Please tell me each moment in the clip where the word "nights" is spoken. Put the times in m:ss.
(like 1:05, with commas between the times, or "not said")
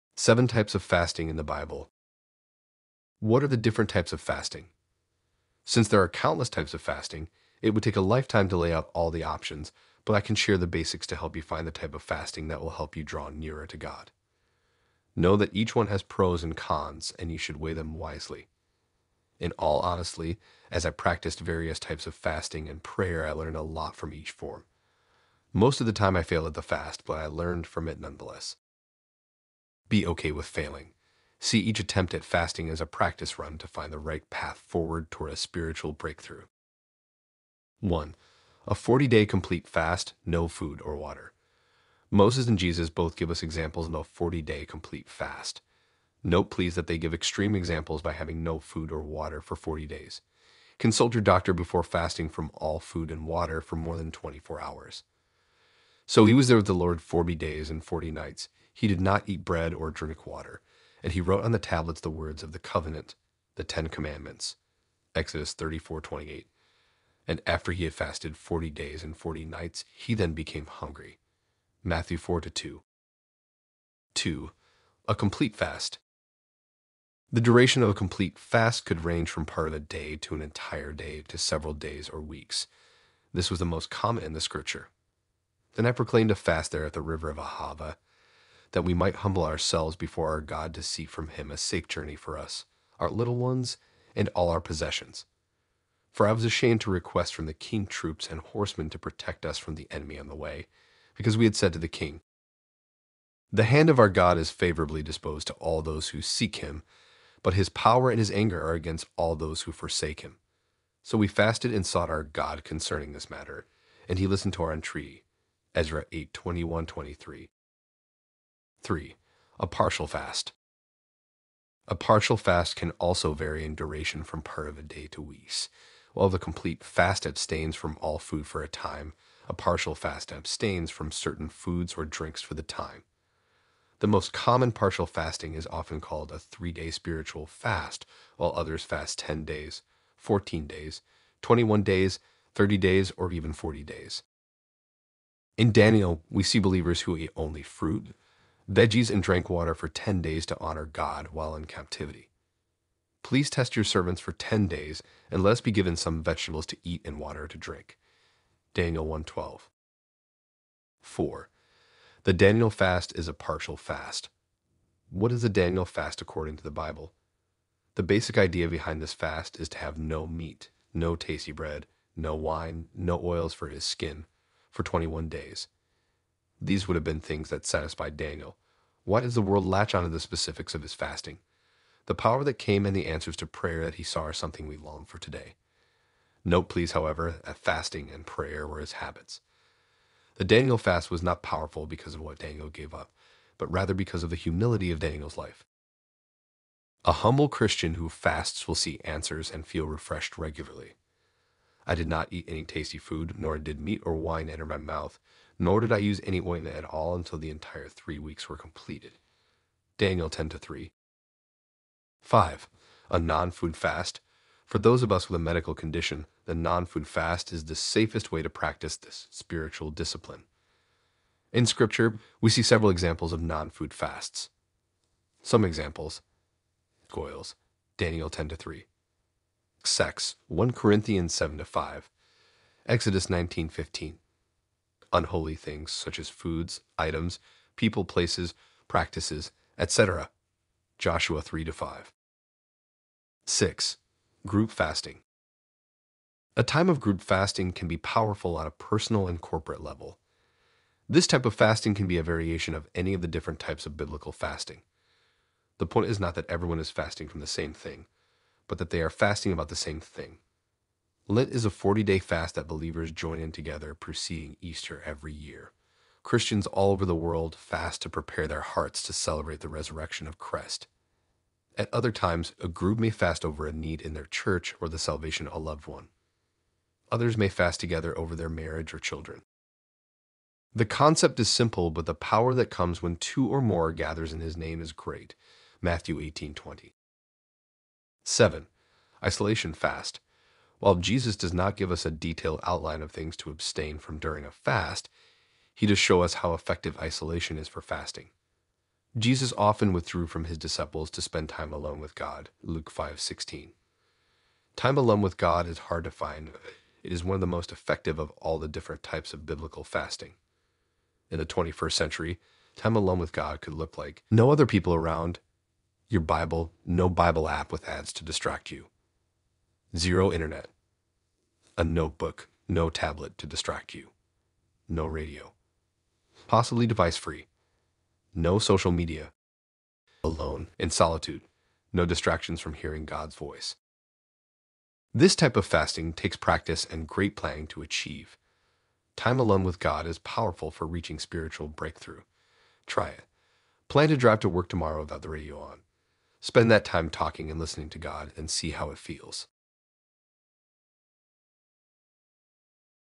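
0:58, 1:09.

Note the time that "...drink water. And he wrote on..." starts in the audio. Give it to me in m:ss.
0:59.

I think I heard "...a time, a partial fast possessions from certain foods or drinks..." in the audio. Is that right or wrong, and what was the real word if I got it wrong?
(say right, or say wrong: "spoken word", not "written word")
wrong: "abstains", not "possessions".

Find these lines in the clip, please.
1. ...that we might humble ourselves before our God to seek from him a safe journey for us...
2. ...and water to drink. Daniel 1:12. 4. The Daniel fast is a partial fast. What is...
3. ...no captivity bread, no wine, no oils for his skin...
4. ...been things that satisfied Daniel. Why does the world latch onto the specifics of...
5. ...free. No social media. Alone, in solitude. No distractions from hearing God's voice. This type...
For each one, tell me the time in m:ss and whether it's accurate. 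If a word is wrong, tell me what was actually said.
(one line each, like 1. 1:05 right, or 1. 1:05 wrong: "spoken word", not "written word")
1. 1:28 right
2. 2:37 right
3. 2:50 wrong: "tasty", not "captivity"
4. 2:57 right
5. 5:27 right.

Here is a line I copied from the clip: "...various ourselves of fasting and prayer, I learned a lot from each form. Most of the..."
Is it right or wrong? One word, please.
wrong.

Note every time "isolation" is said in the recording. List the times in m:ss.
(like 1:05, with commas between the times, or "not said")
4:49, 4:56.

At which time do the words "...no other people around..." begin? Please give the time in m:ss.
5:14.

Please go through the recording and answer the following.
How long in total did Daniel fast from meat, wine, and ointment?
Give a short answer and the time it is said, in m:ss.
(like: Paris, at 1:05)
3 weeks, at 3:27.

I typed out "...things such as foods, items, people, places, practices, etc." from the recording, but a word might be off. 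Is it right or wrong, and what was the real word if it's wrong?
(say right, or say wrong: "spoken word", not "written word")
right.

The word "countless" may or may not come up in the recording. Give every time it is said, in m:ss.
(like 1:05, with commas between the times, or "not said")
0:06.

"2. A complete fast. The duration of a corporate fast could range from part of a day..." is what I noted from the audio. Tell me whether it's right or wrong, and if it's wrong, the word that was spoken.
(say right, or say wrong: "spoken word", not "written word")
wrong: "complete", not "corporate".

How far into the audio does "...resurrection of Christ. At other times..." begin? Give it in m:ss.
4:29.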